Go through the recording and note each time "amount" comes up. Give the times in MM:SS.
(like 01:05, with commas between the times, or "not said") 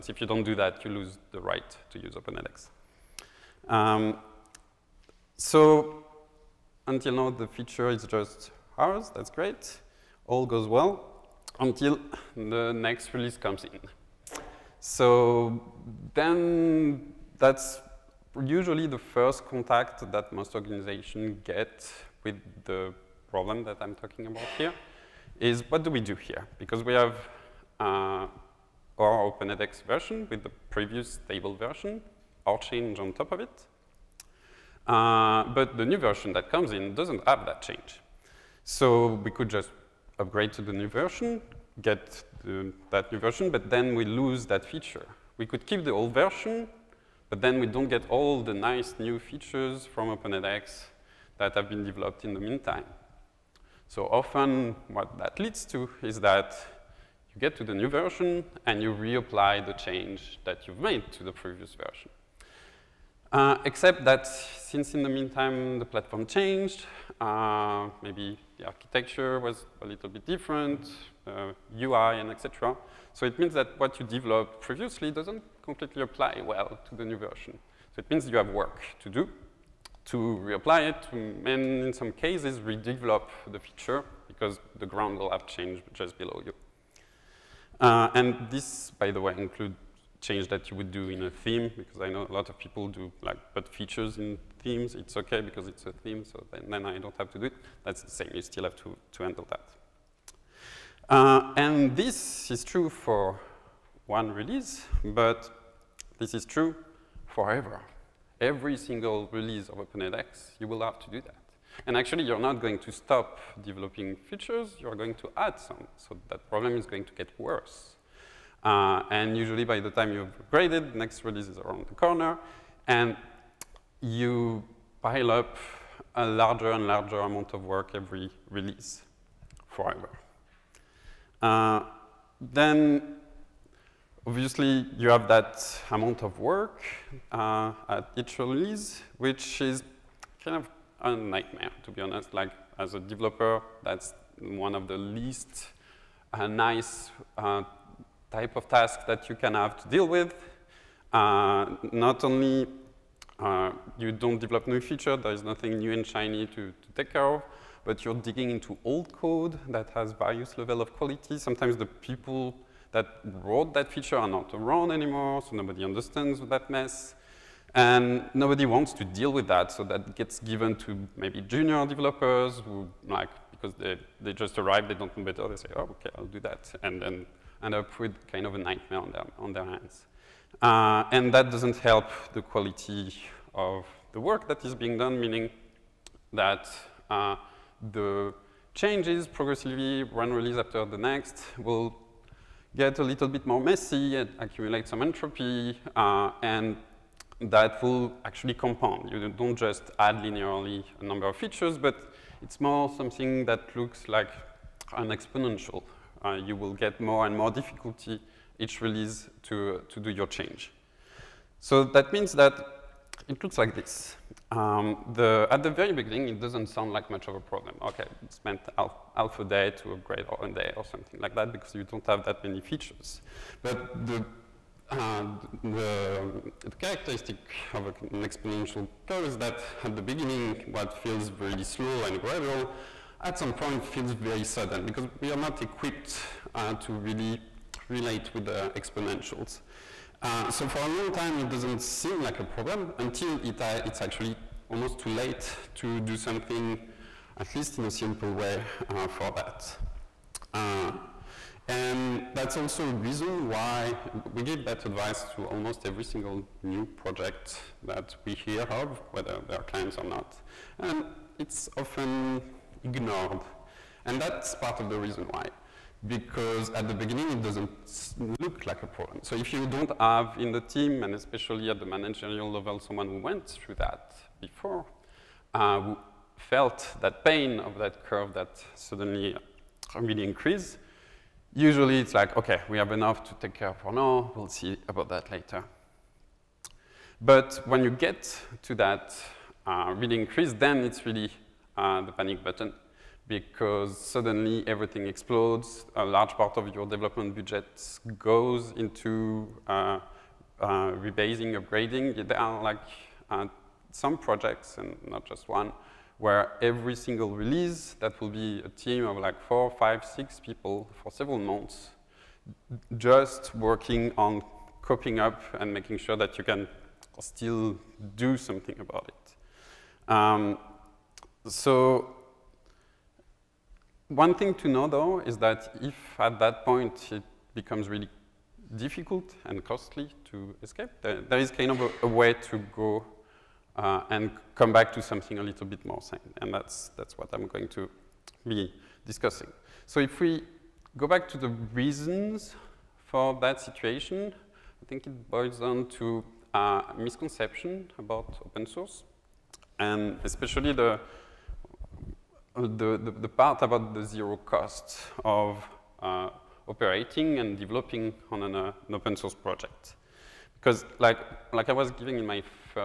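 02:07, 02:15.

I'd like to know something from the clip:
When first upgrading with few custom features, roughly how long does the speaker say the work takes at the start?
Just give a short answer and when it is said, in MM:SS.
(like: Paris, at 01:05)
Half a day, at 03:39.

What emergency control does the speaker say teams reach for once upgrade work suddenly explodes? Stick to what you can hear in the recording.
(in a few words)
The panic button.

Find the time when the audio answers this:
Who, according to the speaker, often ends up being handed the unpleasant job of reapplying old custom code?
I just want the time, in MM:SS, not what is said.
02:51.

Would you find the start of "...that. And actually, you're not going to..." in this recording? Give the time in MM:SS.
01:51.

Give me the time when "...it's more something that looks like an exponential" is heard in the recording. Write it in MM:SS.
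03:22.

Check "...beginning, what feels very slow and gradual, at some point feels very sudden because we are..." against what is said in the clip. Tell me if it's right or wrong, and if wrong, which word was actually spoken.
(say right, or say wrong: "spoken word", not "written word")
right.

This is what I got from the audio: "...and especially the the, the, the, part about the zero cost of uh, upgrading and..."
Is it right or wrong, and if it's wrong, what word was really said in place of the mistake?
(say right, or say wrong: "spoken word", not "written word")
wrong: "operating", not "upgrading".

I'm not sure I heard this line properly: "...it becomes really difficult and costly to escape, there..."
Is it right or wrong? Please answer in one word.
right.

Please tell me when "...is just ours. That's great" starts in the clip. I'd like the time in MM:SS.
00:07.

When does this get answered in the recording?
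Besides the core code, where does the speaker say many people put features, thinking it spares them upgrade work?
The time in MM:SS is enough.
01:34.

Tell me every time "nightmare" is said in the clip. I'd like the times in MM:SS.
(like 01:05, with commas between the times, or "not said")
02:21, 02:58.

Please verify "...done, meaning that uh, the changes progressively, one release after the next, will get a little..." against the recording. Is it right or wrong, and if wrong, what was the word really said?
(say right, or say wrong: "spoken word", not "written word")
right.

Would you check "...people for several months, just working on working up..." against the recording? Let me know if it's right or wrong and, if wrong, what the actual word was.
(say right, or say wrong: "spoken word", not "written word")
wrong: "coping", not "working".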